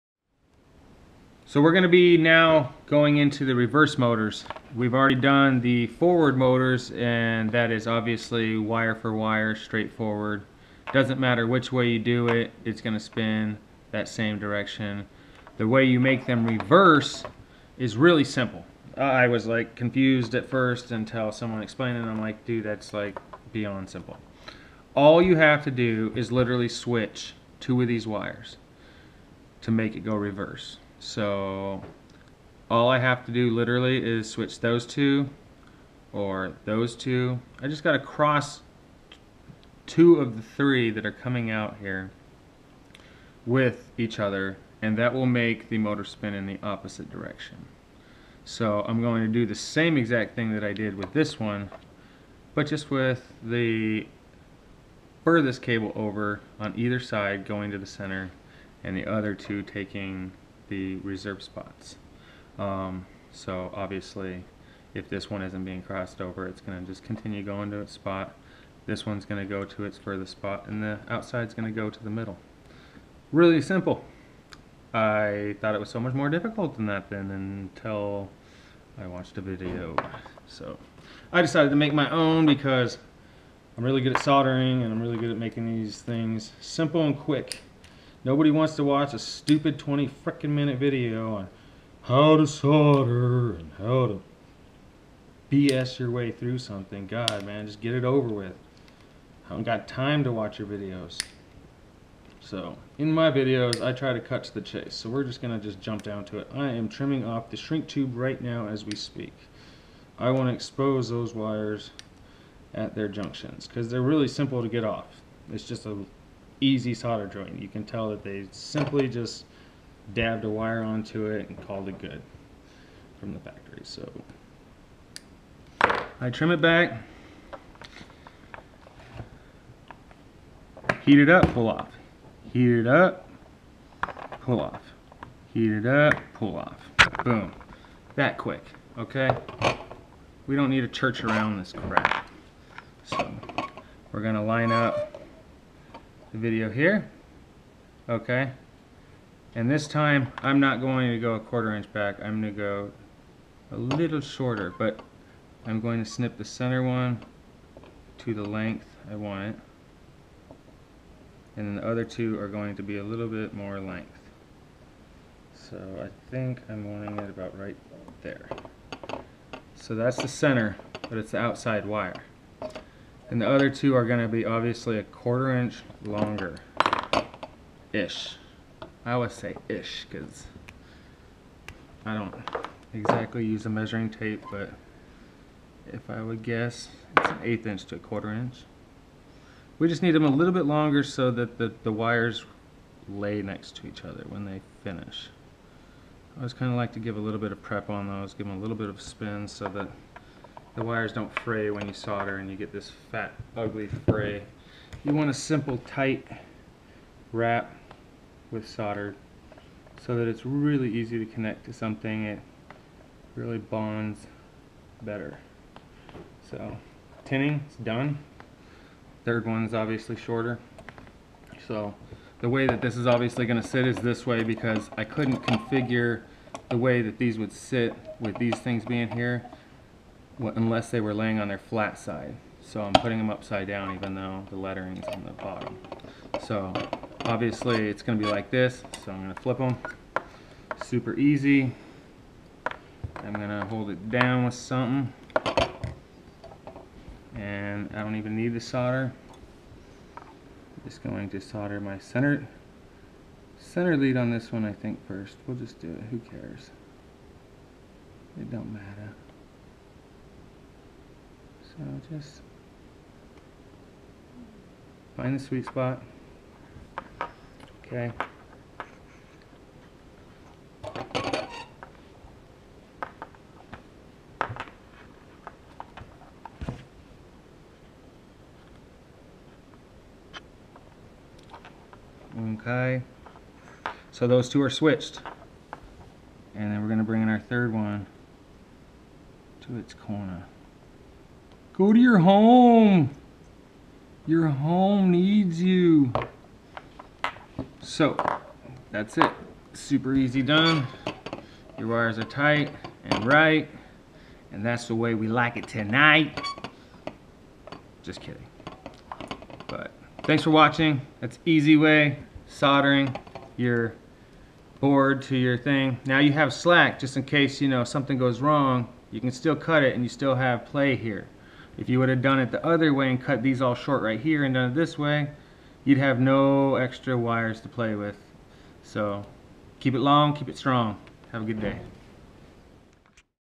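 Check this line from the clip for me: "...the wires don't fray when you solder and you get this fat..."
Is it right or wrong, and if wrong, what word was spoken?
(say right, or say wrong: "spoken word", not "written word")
right.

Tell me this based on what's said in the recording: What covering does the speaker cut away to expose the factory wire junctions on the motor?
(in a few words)
shrink tube.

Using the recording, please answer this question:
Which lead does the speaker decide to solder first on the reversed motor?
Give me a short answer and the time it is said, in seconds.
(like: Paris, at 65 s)
center lead, at 251 s.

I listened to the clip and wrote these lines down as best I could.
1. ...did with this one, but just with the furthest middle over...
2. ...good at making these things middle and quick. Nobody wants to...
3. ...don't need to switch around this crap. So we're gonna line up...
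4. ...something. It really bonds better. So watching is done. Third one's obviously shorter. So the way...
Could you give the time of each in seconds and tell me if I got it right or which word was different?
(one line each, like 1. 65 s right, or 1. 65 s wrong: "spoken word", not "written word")
1. 50 s wrong: "cable", not "middle"
2. 85 s wrong: "simple", not "middle"
3. 140 s wrong: "church", not "switch"
4. 211 s wrong: "tinning", not "watching".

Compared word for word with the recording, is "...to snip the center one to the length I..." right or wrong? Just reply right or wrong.
right.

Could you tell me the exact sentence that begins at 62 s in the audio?
Um, so obviously if this one isn't being crossed over it's going to just continue going to its spot.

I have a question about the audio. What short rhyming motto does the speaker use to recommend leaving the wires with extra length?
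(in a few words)
keep it long, keep it strong.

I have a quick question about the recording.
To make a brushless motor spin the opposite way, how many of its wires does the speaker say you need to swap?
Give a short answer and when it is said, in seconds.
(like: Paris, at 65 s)
2, at 26 s.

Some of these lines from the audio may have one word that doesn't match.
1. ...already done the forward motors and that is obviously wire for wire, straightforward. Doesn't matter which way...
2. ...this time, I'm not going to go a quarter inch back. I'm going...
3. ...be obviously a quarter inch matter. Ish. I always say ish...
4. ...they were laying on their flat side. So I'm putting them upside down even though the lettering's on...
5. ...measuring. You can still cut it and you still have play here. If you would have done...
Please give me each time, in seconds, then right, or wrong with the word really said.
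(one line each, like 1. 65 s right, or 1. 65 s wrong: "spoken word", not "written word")
1. 4 s right
2. 149 s right
3. 174 s wrong: "longer", not "matter"
4. 230 s right
5. 318 s wrong: "wrong", not "measuring".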